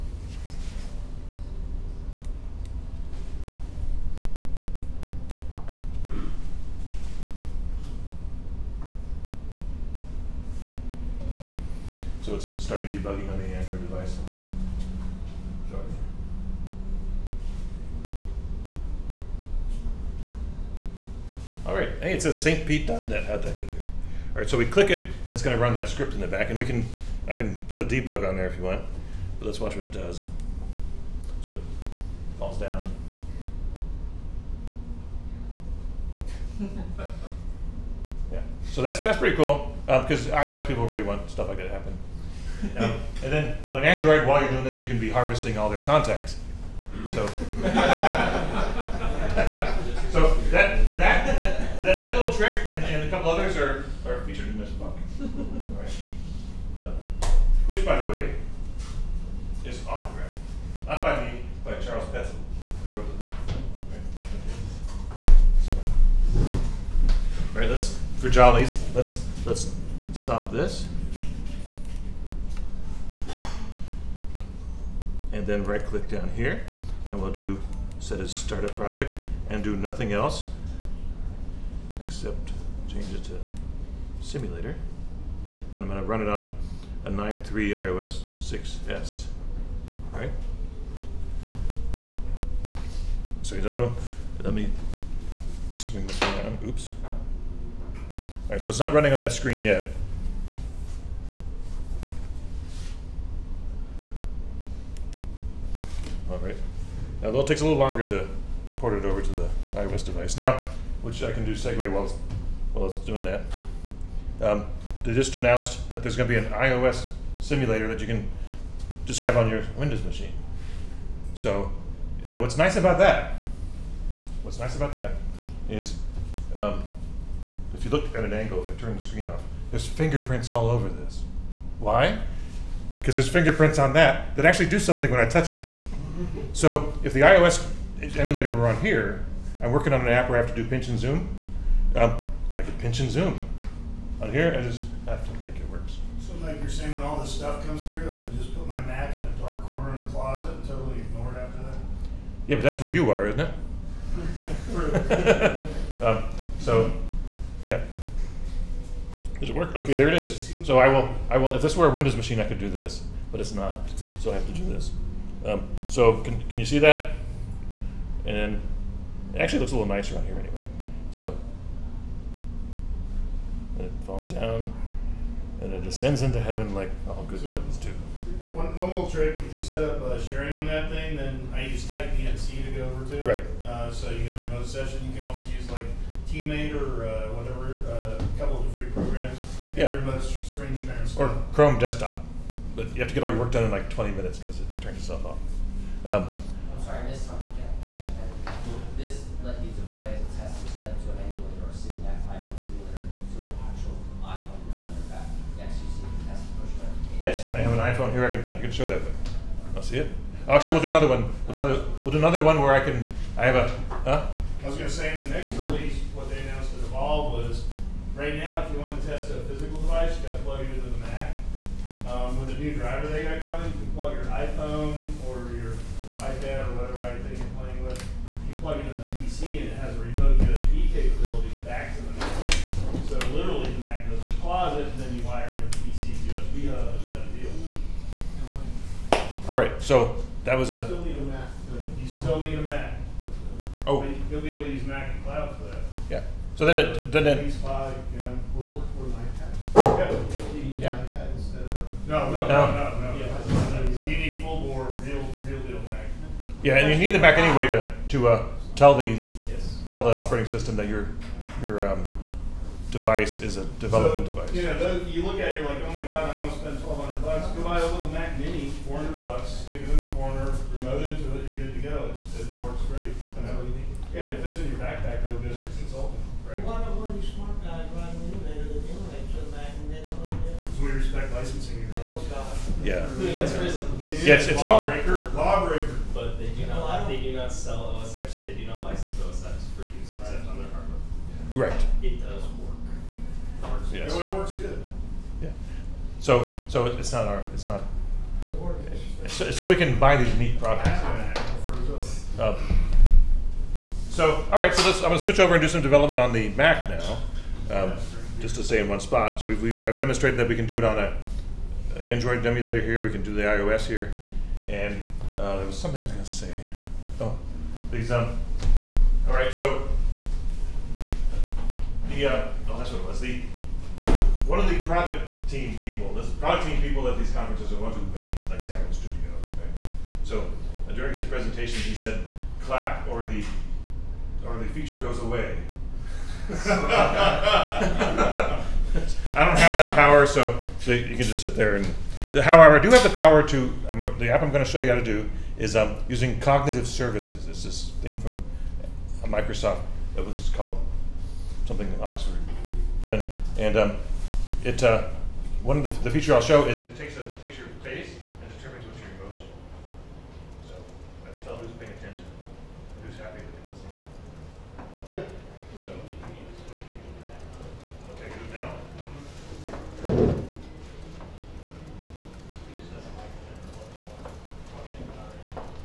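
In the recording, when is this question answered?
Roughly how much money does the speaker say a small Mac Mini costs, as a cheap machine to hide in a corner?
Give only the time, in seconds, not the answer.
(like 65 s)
268 s.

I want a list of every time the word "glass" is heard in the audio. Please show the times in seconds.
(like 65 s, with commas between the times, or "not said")
not said.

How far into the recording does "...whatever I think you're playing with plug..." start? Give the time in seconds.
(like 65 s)
226 s.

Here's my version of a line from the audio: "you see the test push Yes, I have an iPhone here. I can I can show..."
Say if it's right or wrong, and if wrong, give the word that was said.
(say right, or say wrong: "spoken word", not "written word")
right.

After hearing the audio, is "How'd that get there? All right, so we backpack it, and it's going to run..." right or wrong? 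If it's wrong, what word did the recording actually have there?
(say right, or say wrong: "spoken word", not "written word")
wrong: "click", not "backpack".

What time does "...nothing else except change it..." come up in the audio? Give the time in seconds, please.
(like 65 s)
79 s.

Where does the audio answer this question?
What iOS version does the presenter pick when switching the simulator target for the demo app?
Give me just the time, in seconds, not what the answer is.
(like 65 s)
87 s.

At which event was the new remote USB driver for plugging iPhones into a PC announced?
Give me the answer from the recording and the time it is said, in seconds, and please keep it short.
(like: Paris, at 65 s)
Evolve, at 216 s.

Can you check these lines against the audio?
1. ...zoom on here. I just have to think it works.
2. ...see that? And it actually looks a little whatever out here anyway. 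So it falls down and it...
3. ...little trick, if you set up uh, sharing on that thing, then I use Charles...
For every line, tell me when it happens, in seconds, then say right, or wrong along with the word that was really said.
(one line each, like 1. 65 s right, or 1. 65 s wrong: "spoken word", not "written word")
1. 143 s right
2. 166 s wrong: "nicer", not "whatever"
3. 178 s wrong: "TightVNC", not "Charles".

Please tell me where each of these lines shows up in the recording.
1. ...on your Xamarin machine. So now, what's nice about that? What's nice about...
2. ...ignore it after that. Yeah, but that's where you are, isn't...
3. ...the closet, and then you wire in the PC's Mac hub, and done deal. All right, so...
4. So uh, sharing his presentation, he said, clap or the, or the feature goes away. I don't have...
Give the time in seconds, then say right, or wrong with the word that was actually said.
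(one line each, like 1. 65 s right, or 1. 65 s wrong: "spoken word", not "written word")
1. 119 s wrong: "Windows", not "Xamarin"
2. 151 s right
3. 234 s wrong: "USB", not "Mac"
4. 330 s wrong: "during", not "sharing".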